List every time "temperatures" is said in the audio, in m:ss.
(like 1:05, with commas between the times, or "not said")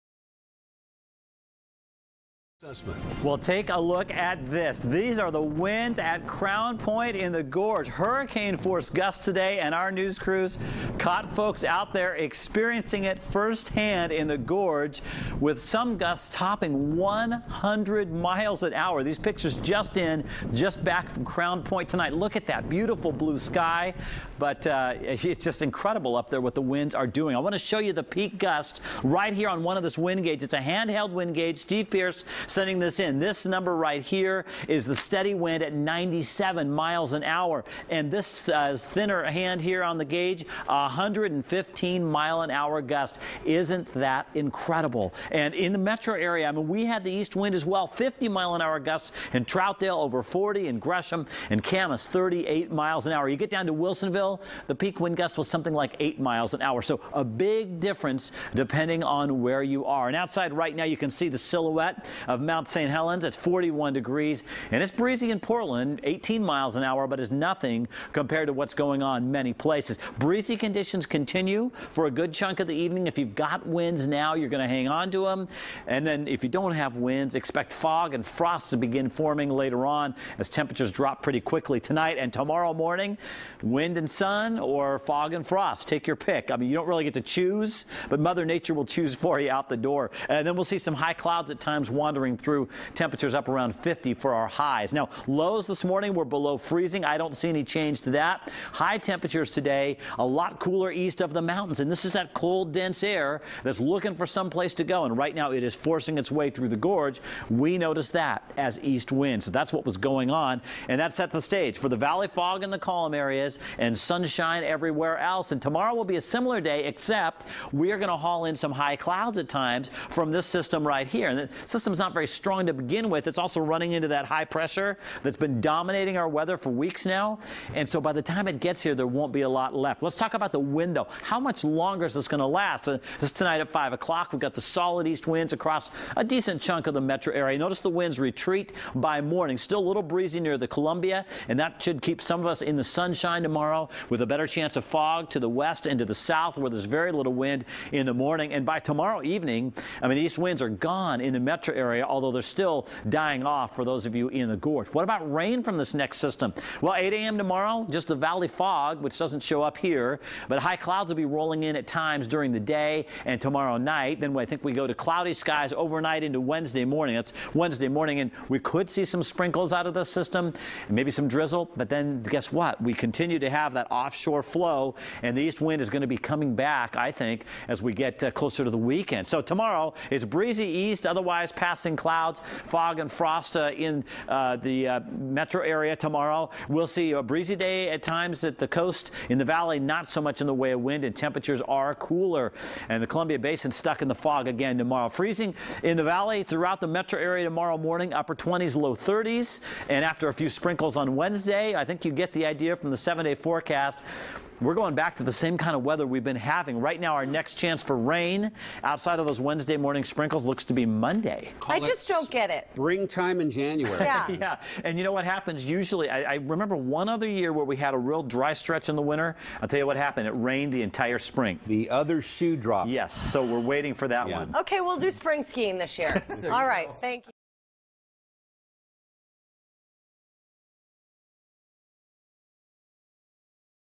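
1:20, 1:32, 1:38, 3:11.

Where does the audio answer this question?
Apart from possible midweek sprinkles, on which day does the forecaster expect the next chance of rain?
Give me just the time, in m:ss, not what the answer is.
3:30.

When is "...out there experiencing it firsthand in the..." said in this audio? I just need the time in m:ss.
0:11.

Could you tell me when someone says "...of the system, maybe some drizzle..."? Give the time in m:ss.
2:49.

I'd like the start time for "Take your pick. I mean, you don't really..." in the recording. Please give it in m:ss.
1:25.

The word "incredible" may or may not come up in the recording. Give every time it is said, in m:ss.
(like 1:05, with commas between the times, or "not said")
0:25, 0:44.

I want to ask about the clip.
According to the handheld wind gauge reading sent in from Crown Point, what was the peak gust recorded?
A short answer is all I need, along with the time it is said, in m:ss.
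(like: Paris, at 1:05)
115 mph, at 0:40.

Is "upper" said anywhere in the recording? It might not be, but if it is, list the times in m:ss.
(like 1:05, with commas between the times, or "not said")
3:18.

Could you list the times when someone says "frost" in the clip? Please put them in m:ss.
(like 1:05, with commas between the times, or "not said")
1:18, 1:25, 3:03.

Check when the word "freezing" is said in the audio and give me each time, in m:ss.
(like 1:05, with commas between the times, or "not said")
1:36, 3:15.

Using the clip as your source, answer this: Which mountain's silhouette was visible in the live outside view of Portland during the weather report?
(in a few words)
Mount St. Helens.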